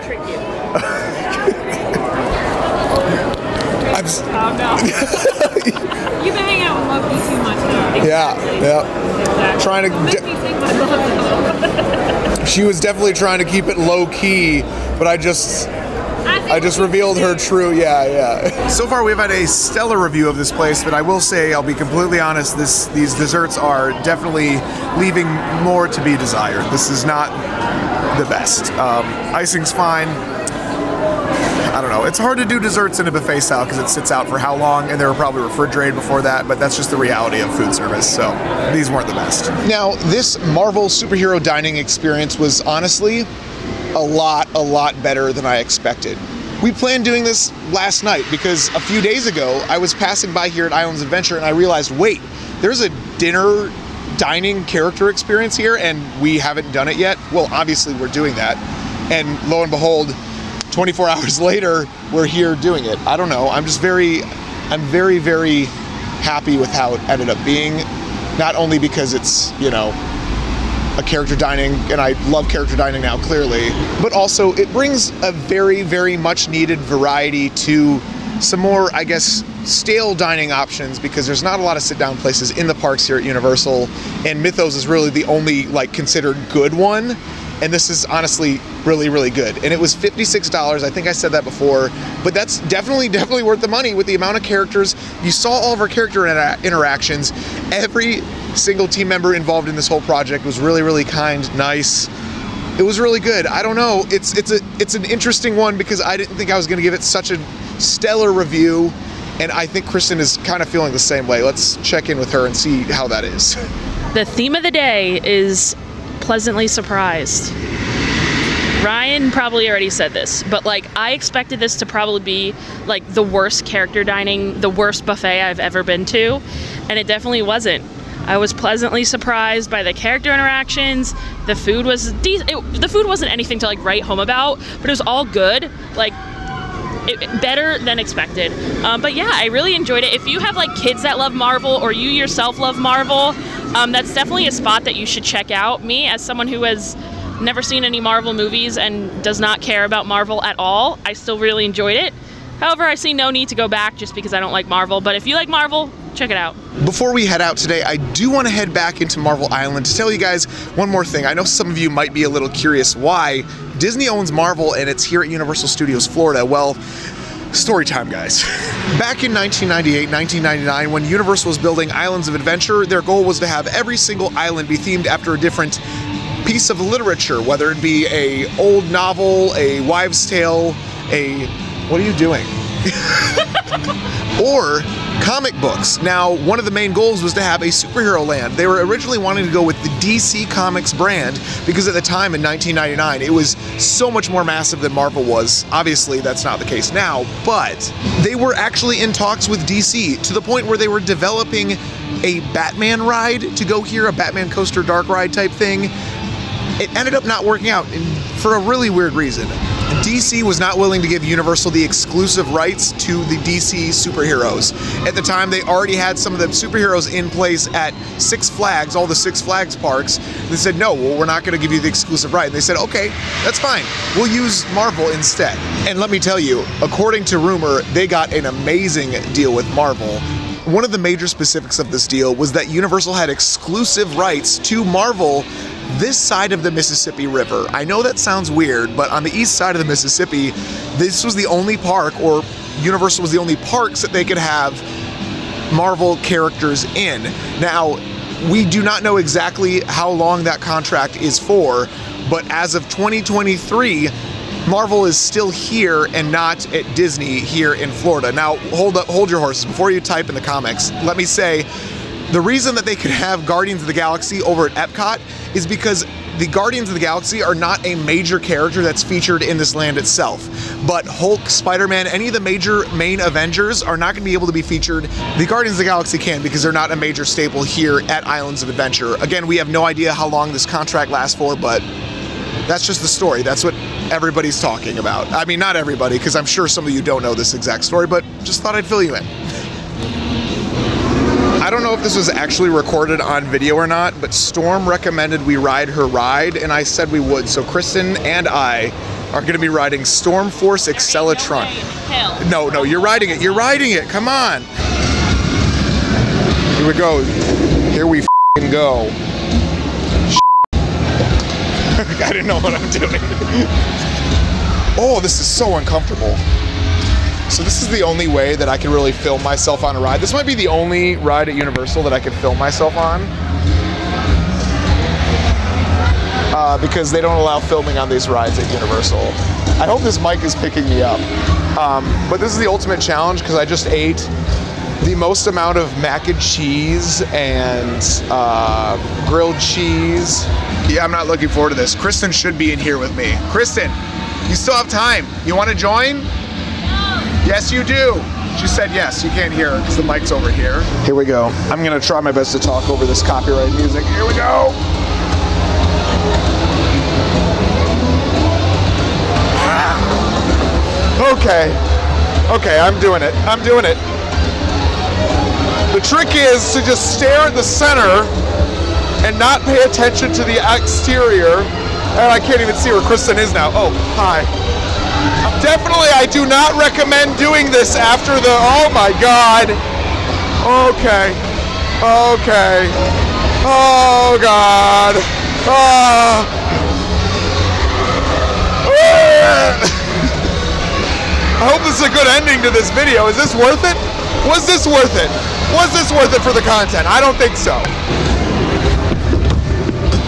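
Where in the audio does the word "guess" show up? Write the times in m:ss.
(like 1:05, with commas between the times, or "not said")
1:19.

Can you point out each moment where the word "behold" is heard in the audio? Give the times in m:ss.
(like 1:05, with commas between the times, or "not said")
0:59.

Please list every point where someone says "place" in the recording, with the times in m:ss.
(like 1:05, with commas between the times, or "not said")
0:20, 1:22, 3:37.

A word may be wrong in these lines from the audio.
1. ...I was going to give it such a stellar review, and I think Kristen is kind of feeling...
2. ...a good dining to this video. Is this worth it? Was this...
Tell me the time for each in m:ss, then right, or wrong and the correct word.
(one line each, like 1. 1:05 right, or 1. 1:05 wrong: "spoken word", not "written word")
1. 1:46 right
2. 6:32 wrong: "ending", not "dining".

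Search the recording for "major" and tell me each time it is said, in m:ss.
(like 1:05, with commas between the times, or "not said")
3:50, 4:27, 4:32, 4:36.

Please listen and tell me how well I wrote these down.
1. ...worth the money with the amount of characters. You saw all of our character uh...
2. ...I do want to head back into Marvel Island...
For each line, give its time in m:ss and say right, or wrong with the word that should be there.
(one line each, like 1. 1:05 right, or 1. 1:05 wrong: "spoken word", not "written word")
1. 1:33 right
2. 2:37 right.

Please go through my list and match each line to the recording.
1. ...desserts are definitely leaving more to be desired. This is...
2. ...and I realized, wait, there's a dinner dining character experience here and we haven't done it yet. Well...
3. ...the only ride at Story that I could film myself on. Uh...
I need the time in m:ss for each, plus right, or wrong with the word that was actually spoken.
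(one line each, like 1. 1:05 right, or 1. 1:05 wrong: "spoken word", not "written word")
1. 0:23 right
2. 0:51 right
3. 5:20 wrong: "Universal", not "Story".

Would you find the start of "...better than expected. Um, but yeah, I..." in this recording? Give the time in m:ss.
2:17.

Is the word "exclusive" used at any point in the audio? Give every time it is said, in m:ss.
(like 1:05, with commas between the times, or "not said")
3:31, 3:41, 3:53.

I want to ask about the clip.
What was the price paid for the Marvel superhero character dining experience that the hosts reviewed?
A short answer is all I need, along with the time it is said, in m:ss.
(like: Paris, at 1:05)
$56, at 1:29.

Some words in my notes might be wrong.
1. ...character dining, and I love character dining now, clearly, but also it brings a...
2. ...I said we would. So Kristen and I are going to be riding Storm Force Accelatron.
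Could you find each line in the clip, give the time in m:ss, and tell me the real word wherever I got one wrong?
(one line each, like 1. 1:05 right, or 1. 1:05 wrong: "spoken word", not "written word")
1. 1:11 right
2. 4:56 right.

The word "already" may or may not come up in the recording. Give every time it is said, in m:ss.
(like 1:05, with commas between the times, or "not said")
1:59, 3:35.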